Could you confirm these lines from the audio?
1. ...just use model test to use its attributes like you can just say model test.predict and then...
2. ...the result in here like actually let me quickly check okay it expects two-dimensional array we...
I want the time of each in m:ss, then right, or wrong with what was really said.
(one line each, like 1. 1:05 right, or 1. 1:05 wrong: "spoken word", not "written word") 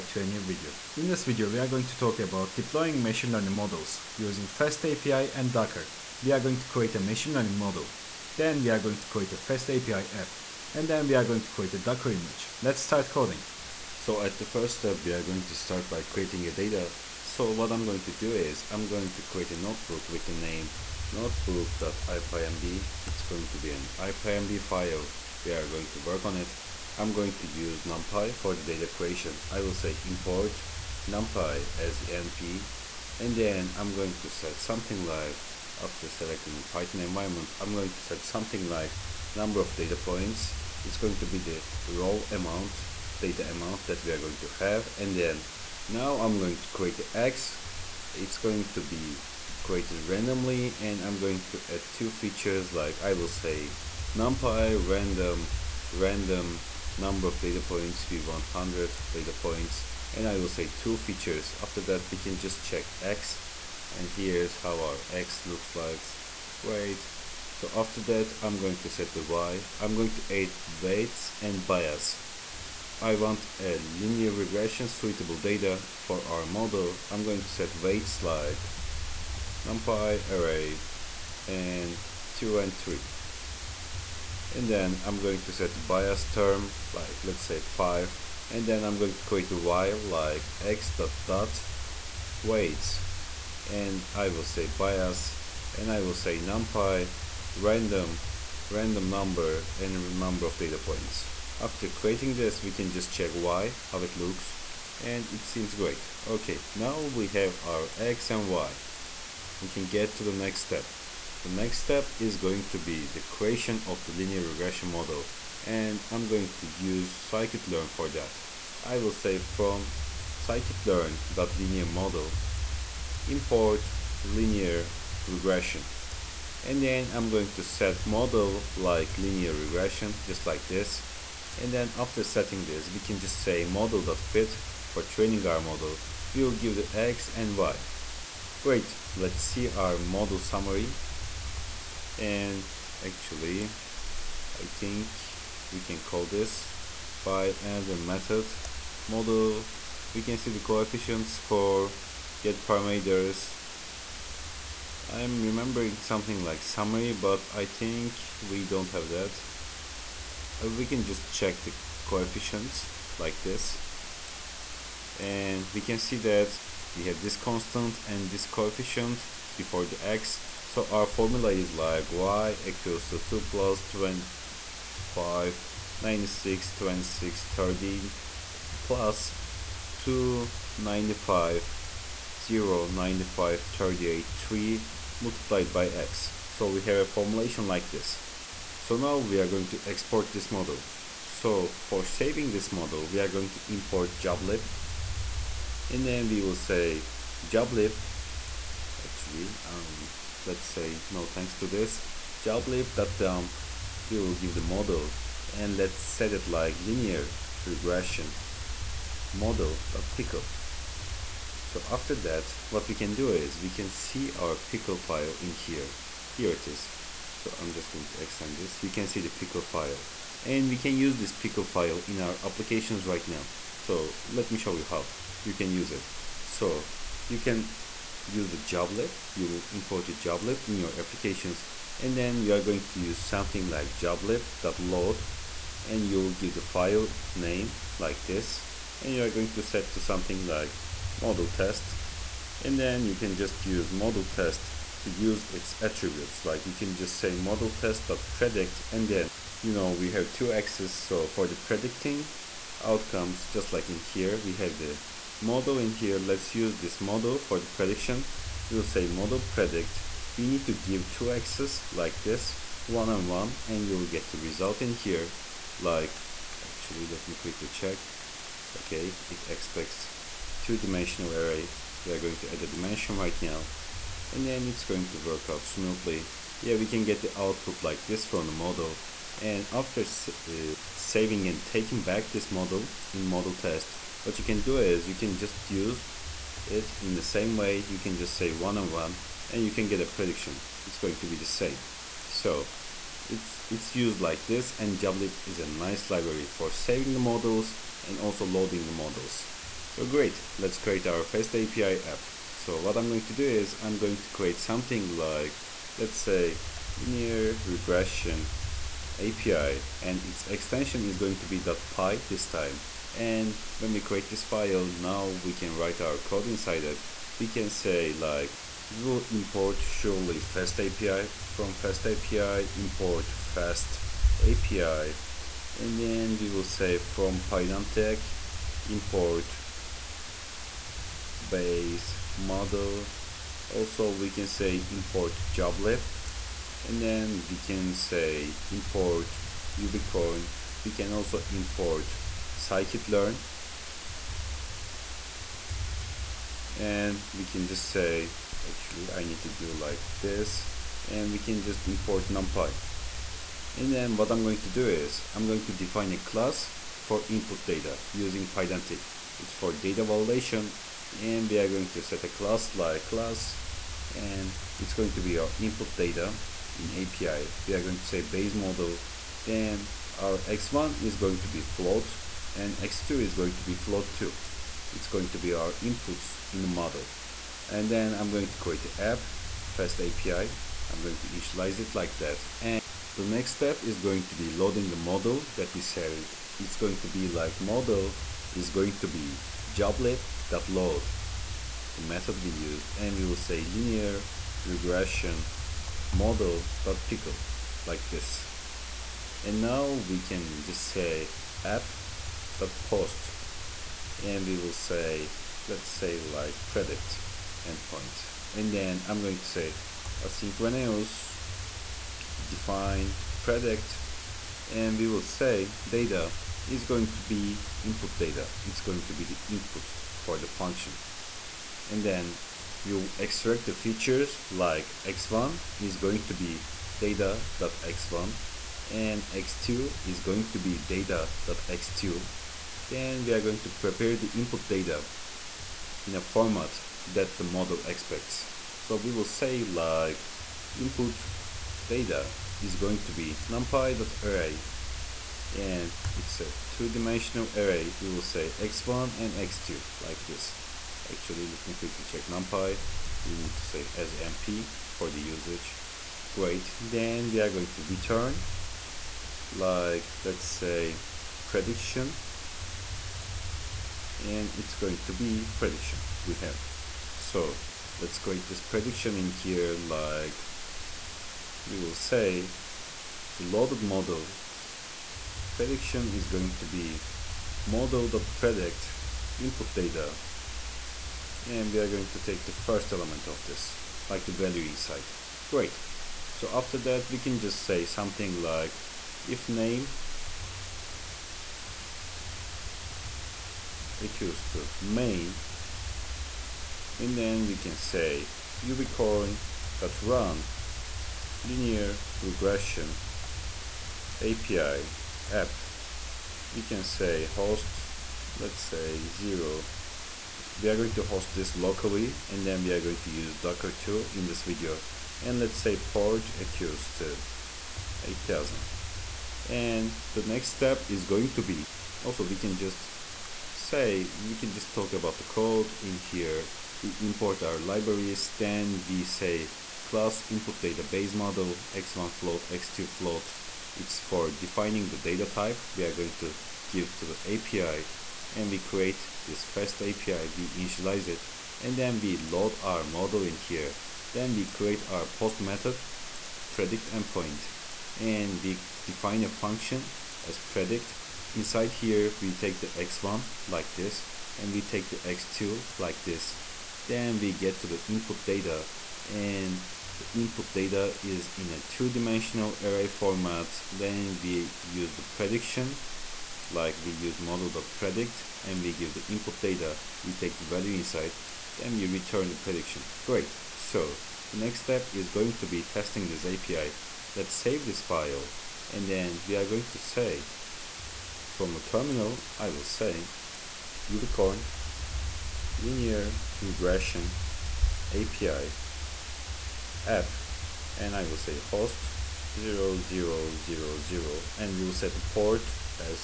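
1. 4:03 right
2. 4:24 right.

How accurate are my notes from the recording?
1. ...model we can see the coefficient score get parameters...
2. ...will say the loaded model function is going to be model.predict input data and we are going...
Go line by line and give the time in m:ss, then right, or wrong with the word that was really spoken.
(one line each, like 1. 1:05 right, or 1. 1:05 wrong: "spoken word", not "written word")
1. 2:29 right
2. 7:51 wrong: "prediction", not "function".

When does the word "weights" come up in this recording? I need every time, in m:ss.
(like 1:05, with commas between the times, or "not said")
1:10, 1:17, 1:32.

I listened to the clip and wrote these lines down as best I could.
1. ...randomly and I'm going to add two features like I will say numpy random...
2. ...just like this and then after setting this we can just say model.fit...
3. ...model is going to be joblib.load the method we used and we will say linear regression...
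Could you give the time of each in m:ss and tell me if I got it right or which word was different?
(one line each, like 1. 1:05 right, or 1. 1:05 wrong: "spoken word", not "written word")
1. 0:50 right
2. 2:10 right
3. 6:27 right.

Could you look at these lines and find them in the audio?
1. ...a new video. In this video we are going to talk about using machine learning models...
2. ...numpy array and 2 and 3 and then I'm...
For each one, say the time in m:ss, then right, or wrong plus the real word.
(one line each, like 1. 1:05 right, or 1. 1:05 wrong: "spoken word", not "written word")
1. 0:00 wrong: "deploying", not "using"
2. 1:19 right.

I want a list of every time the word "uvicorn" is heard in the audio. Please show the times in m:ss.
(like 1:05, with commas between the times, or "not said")
5:39, 8:18, 9:43.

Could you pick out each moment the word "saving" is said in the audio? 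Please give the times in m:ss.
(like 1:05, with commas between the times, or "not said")
3:12, 4:40, 4:56.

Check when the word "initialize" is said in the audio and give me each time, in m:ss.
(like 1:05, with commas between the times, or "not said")
6:21, 9:00.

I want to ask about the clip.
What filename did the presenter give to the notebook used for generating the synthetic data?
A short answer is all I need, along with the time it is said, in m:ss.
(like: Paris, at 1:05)
notebook.ipynb, at 0:21.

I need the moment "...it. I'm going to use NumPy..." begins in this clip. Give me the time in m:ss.
0:26.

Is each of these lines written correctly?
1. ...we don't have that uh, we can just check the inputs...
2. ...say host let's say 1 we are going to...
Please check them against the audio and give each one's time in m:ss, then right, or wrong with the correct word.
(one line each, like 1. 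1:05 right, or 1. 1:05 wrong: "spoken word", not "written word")
1. 2:38 wrong: "coefficients", not "inputs"
2. 8:26 wrong: "0", not "1".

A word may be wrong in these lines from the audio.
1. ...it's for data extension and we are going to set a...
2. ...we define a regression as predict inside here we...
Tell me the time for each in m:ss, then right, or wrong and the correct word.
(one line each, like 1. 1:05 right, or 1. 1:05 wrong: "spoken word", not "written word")
1. 5:59 wrong: "validation", not "extension"
2. 9:08 wrong: "function", not "regression".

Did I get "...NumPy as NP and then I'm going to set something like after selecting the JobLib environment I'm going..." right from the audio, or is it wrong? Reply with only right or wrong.
wrong.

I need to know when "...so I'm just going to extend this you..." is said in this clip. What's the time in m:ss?
3:37.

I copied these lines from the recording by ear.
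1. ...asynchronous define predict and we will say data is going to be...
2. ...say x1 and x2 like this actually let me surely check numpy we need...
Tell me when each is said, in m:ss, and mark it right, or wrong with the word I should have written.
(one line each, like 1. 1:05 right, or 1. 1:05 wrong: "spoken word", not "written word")
1. 6:50 right
2. 7:28 wrong: "quickly", not "surely".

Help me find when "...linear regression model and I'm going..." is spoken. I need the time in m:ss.
1:54.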